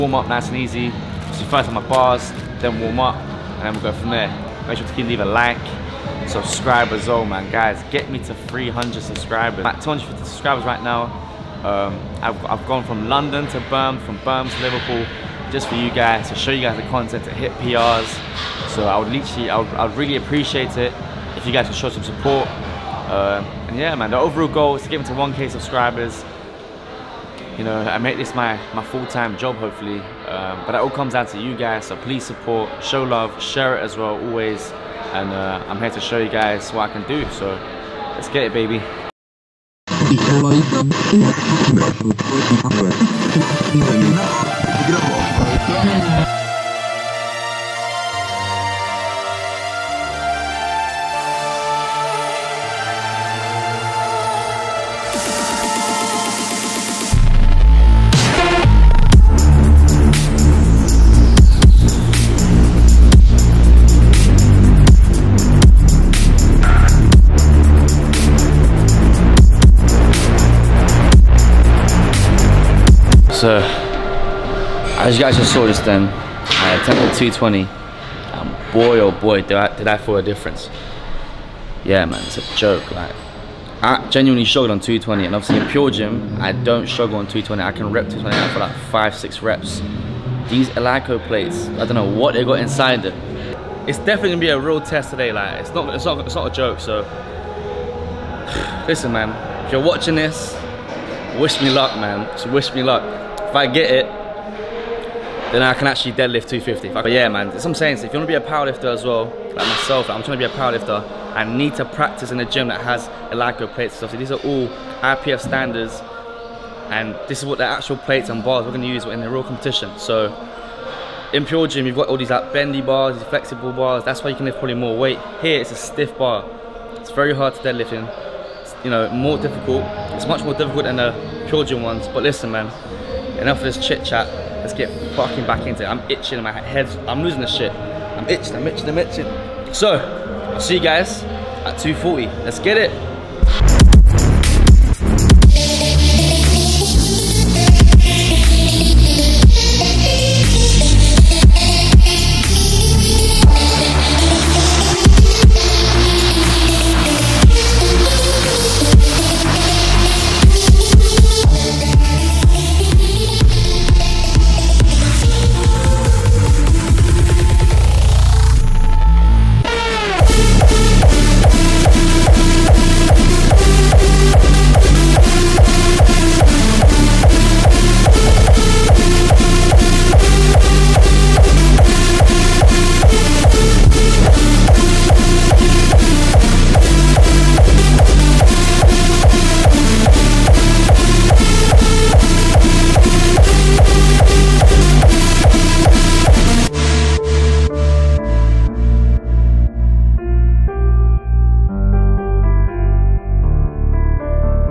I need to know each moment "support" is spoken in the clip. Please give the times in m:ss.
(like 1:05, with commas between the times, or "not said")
0:22, 0:32.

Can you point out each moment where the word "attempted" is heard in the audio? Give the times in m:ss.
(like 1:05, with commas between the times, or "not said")
1:16.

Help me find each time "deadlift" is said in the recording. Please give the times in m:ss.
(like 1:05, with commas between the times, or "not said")
1:46, 2:07.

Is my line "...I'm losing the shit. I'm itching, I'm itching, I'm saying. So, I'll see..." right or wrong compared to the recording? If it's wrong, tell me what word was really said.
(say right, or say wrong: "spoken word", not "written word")
wrong: "itching", not "saying".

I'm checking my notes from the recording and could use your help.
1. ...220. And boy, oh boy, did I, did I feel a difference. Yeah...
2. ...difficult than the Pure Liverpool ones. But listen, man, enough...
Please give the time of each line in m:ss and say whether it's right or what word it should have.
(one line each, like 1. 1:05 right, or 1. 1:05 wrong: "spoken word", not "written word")
1. 1:17 right
2. 2:10 wrong: "Gym", not "Liverpool".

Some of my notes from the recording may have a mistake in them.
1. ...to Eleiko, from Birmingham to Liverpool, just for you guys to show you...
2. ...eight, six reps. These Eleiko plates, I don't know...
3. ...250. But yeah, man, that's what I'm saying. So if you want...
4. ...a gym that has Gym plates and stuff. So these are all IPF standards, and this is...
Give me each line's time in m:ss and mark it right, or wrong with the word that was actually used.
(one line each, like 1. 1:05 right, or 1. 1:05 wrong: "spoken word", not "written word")
1. 0:13 wrong: "Birmingham", not "Eleiko"
2. 1:28 wrong: "five", not "eight"
3. 1:46 right
4. 1:52 wrong: "Eleiko", not "Gym".